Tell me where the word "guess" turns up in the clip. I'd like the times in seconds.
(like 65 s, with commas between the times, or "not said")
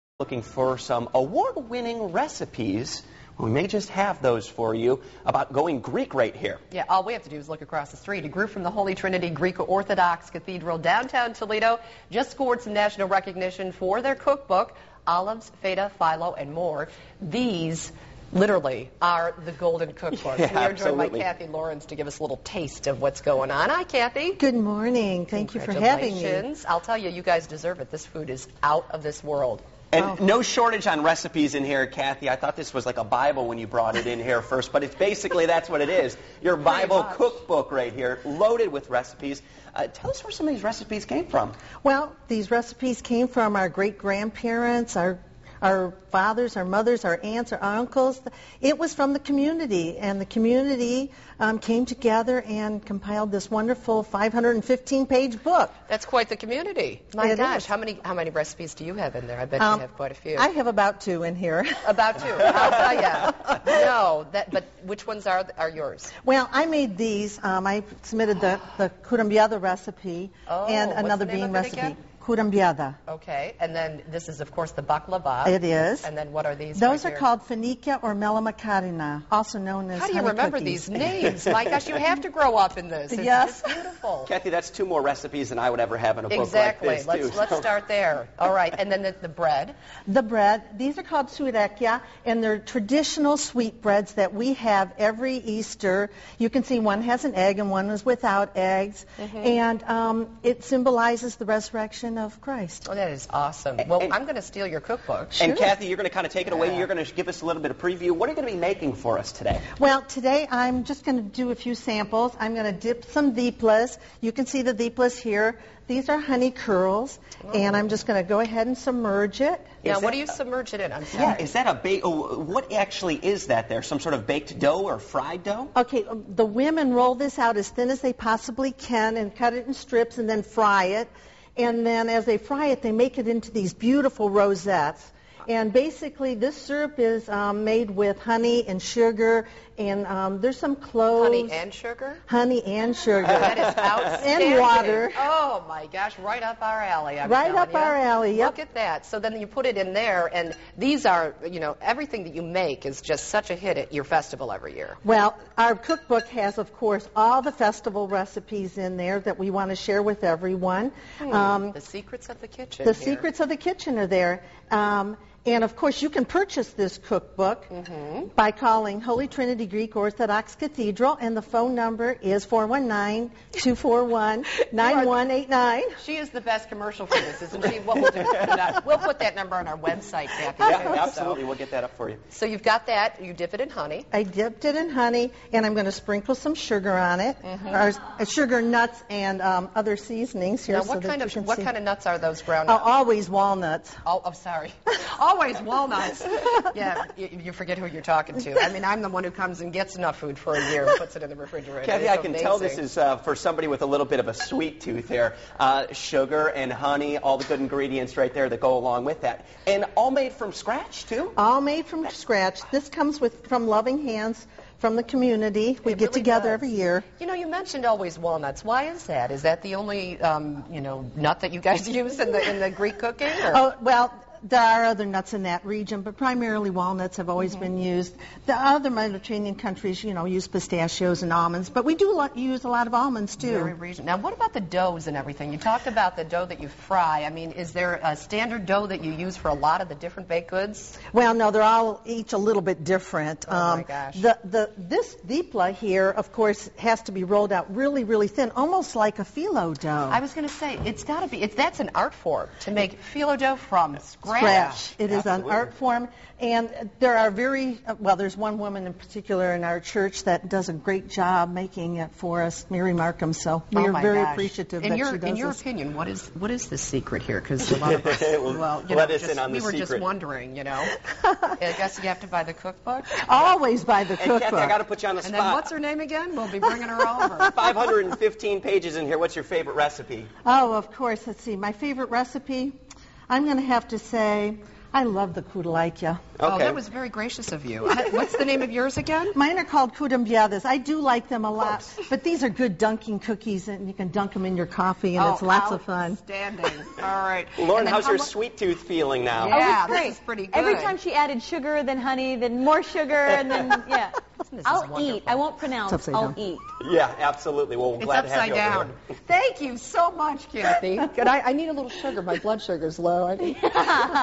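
271 s.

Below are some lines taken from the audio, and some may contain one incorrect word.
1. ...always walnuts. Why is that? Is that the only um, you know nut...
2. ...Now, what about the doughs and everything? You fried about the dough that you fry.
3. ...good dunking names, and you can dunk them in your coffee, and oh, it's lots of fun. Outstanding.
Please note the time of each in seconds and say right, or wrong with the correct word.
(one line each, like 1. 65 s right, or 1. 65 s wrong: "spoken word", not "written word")
1. 217 s right
2. 234 s wrong: "talked", not "fried"
3. 292 s wrong: "cookies", not "names".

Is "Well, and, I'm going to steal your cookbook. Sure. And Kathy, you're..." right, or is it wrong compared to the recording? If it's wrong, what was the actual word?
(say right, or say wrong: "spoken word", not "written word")
right.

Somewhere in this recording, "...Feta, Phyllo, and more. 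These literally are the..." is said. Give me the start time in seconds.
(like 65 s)
15 s.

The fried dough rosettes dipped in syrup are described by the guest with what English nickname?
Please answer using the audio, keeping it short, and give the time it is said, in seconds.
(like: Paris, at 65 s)
honey curls, at 116 s.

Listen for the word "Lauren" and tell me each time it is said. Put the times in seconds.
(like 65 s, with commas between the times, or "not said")
297 s.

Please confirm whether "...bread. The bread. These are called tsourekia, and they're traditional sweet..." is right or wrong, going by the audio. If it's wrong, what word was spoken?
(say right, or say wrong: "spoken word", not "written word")
right.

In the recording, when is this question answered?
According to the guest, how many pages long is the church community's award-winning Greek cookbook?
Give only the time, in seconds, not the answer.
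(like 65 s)
54 s.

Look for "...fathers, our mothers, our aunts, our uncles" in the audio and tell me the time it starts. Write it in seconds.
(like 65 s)
46 s.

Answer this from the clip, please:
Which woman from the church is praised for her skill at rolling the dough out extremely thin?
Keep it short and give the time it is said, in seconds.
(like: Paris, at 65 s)
Mary Markham, at 262 s.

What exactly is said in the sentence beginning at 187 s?
or, uh, sugar, nuts, and um, other seasonings here.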